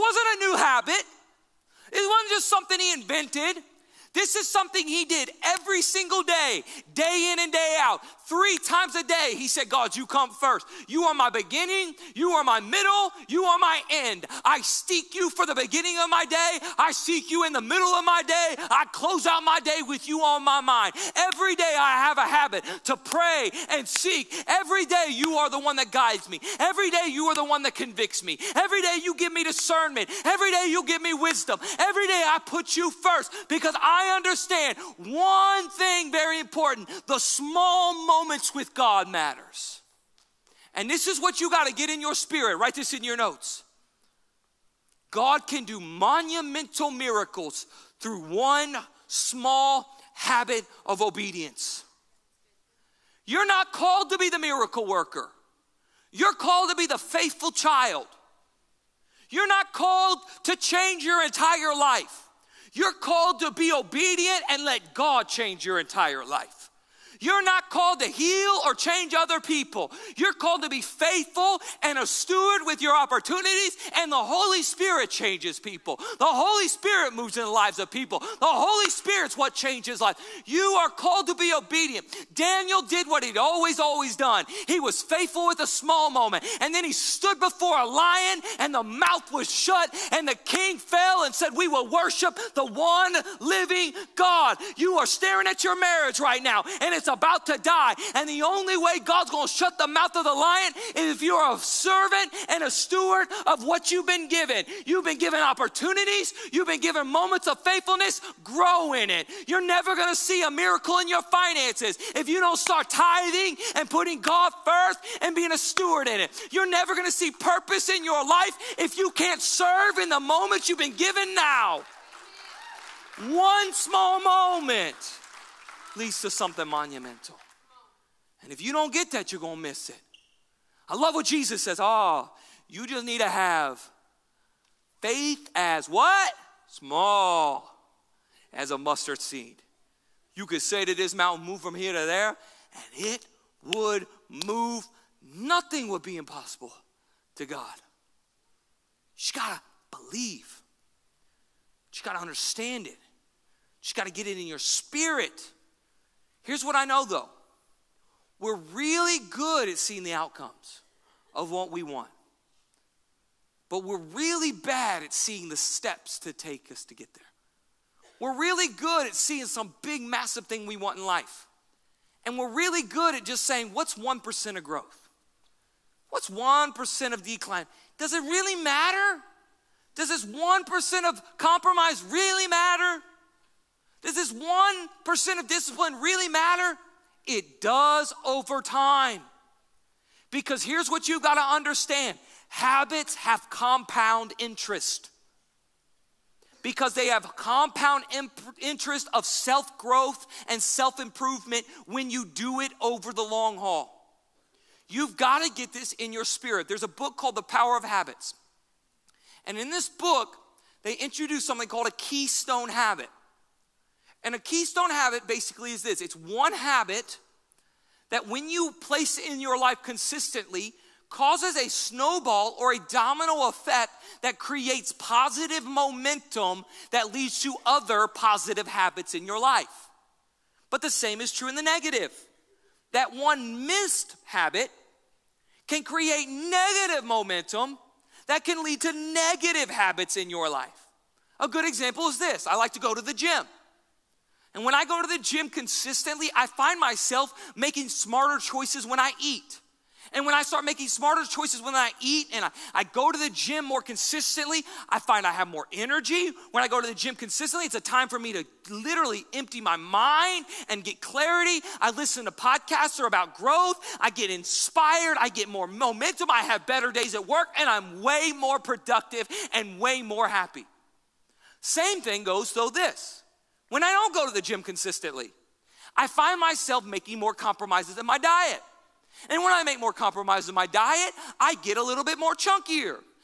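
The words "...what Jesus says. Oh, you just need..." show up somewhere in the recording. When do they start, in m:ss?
2:11.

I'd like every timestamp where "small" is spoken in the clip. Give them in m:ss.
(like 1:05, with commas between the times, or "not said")
0:37, 0:49, 1:25, 2:03, 2:16.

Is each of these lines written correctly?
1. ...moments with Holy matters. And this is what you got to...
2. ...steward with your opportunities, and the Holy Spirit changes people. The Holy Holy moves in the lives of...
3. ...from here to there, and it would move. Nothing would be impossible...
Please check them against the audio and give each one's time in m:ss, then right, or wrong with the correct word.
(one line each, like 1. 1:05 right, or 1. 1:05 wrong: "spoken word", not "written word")
1. 0:38 wrong: "God", not "Holy"
2. 1:12 wrong: "Spirit", not "Holy"
3. 2:21 right.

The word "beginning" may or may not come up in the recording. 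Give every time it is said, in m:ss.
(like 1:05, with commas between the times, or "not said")
0:11, 0:15.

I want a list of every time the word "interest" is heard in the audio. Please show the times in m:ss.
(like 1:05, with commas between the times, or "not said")
3:14, 3:18.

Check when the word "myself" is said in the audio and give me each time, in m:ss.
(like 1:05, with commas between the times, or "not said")
4:06, 4:36.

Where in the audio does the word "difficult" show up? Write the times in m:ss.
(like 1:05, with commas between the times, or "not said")
not said.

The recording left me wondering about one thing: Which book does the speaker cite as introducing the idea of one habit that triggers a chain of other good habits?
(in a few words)
The Power of Habits.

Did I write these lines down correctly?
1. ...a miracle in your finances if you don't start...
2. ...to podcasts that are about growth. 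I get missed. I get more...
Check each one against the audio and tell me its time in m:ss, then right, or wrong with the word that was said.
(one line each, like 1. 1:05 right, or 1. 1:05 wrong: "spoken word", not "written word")
1. 1:50 right
2. 4:22 wrong: "inspired", not "missed".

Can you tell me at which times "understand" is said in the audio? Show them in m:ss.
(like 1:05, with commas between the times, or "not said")
0:34, 2:32, 3:11.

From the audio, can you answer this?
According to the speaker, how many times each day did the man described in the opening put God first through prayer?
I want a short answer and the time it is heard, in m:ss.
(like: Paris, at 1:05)
3, at 0:08.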